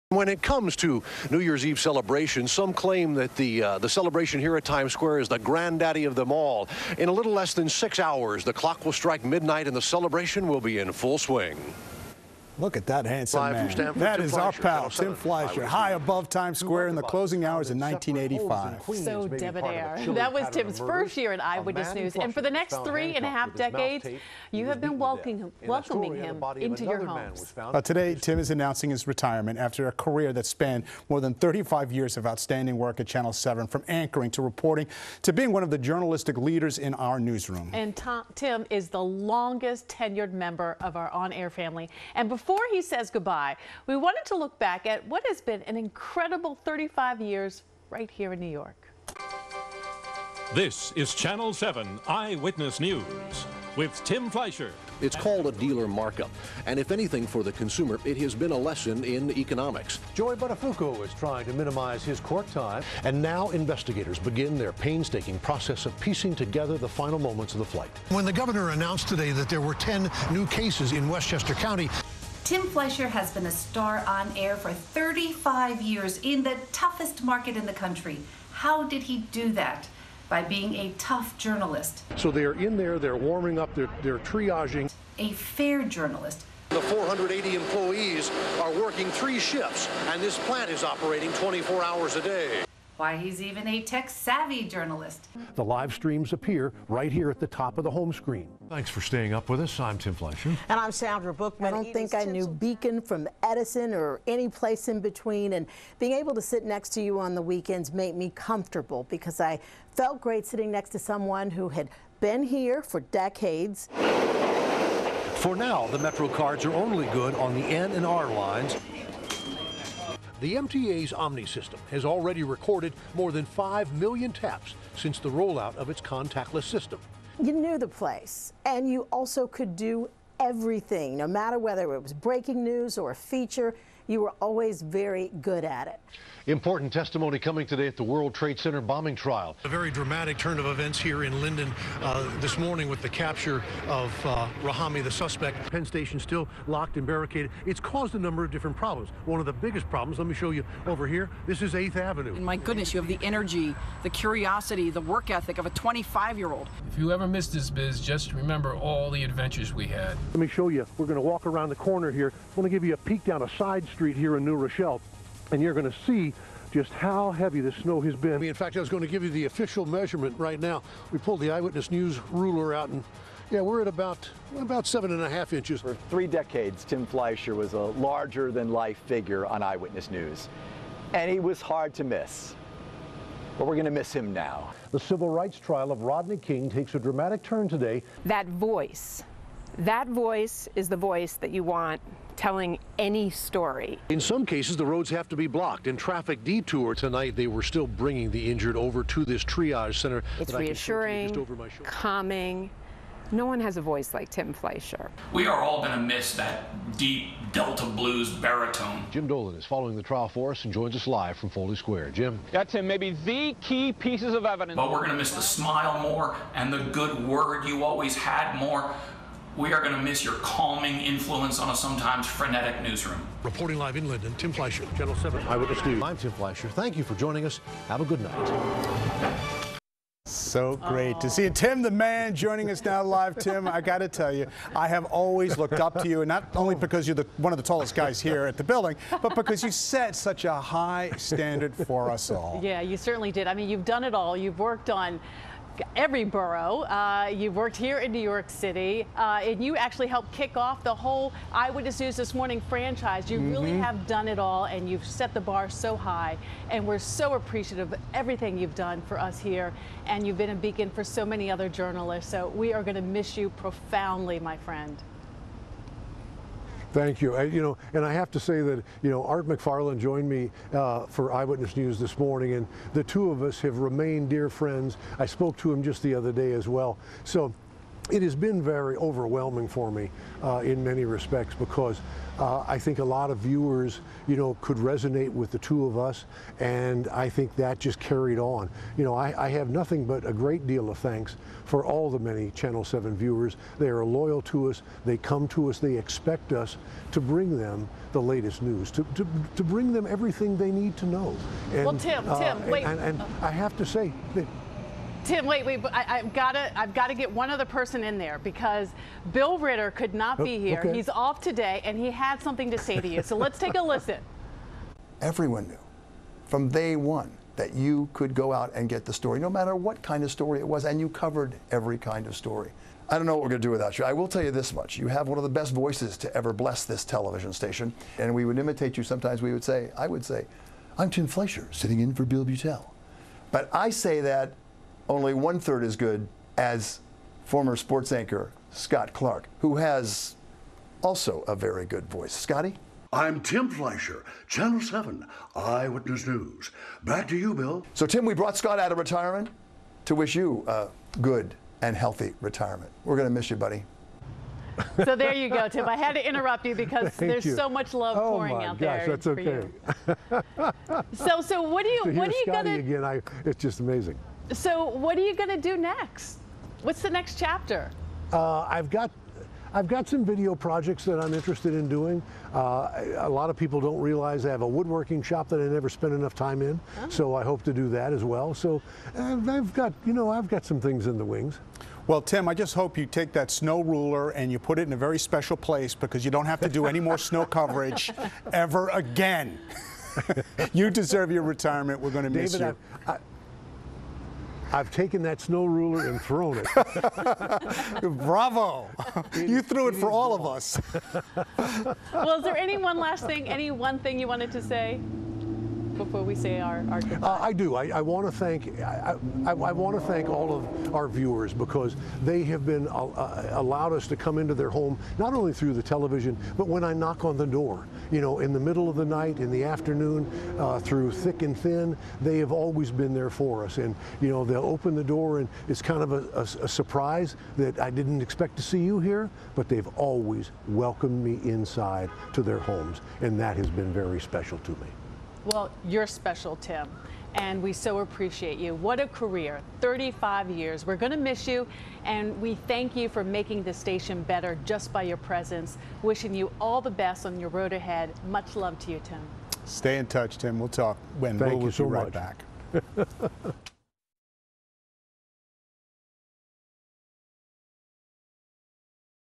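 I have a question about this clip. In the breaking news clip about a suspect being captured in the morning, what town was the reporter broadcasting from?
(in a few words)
Linden.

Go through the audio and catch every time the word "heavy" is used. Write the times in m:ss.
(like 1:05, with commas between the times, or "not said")
2:47.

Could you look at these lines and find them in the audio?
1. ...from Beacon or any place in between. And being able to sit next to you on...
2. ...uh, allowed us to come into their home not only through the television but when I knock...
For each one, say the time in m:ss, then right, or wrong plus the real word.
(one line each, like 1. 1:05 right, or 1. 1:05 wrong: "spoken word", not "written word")
1. 1:43 wrong: "Edison", not "Beacon"
2. 6:53 right.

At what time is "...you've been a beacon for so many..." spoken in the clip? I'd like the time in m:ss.
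4:20.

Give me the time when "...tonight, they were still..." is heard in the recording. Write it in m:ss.
3:16.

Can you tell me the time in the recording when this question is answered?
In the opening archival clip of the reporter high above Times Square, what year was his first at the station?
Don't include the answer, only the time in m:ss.
0:17.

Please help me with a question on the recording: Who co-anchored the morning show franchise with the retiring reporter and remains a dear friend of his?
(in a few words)
Art McFarland.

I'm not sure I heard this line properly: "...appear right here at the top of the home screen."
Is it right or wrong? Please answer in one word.
right.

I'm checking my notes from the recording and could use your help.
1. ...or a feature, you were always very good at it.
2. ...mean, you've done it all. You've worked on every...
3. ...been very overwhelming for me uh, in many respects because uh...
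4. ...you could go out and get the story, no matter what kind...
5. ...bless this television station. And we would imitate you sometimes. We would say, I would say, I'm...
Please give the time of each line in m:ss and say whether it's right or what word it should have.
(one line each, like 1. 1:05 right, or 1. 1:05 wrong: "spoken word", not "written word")
1. 2:12 right
2. 4:03 right
3. 4:38 right
4. 5:17 right
5. 5:26 right.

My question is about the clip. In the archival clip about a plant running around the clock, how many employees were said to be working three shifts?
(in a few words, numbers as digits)
480.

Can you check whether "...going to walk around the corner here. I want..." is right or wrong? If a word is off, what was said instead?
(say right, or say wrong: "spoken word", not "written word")
right.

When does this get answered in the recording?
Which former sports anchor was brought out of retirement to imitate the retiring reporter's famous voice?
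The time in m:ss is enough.
5:38.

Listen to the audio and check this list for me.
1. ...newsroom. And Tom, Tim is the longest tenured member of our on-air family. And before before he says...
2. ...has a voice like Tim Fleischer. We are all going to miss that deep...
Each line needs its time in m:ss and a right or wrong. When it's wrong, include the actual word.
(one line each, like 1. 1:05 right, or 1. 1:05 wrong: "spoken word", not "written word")
1. 0:37 right
2. 3:23 right.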